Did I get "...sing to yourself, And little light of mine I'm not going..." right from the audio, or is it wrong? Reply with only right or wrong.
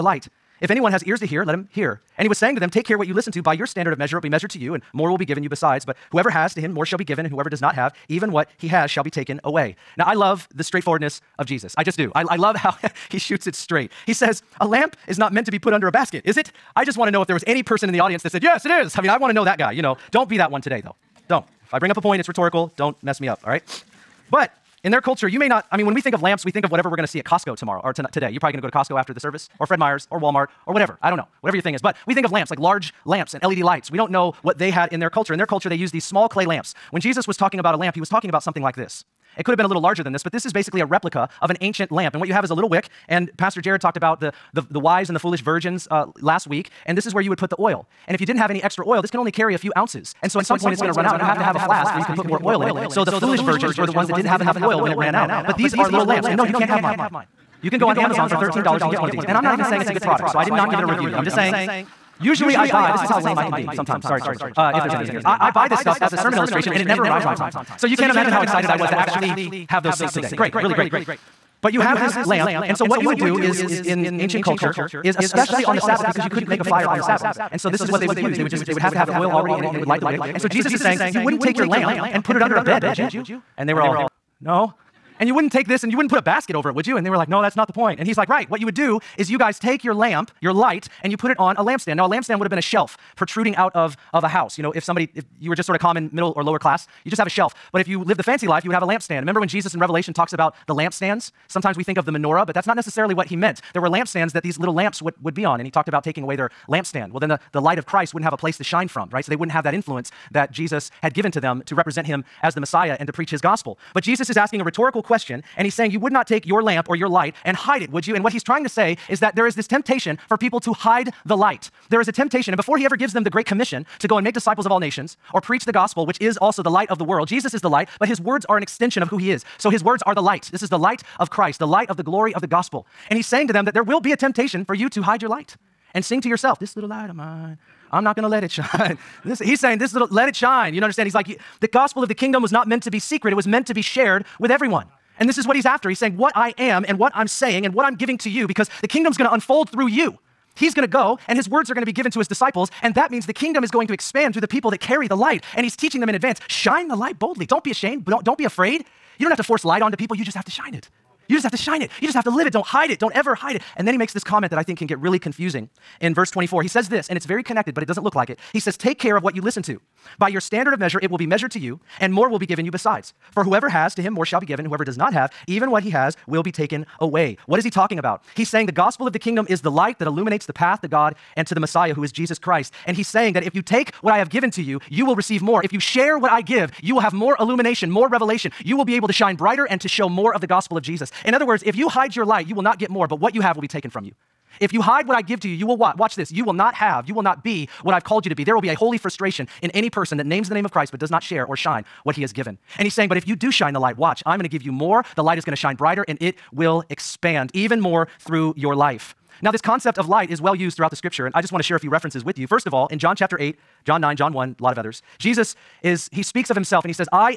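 wrong.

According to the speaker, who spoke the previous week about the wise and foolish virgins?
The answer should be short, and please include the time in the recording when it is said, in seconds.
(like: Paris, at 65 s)
Pastor Jared, at 43 s.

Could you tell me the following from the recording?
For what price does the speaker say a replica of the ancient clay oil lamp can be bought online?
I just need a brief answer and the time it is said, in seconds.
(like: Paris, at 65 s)
$13, at 58 s.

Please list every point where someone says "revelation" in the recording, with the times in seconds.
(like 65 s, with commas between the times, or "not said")
99 s, 188 s.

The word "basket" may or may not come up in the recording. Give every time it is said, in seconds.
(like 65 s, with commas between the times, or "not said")
15 s, 86 s.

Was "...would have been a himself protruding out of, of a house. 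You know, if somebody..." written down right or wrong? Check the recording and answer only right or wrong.
wrong.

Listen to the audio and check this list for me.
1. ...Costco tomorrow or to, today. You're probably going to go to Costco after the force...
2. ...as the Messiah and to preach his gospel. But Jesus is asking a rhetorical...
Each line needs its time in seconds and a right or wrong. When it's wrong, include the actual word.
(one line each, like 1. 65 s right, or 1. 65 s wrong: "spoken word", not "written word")
1. 27 s wrong: "service", not "force"
2. 112 s right.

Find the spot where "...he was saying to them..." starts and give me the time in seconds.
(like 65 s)
2 s.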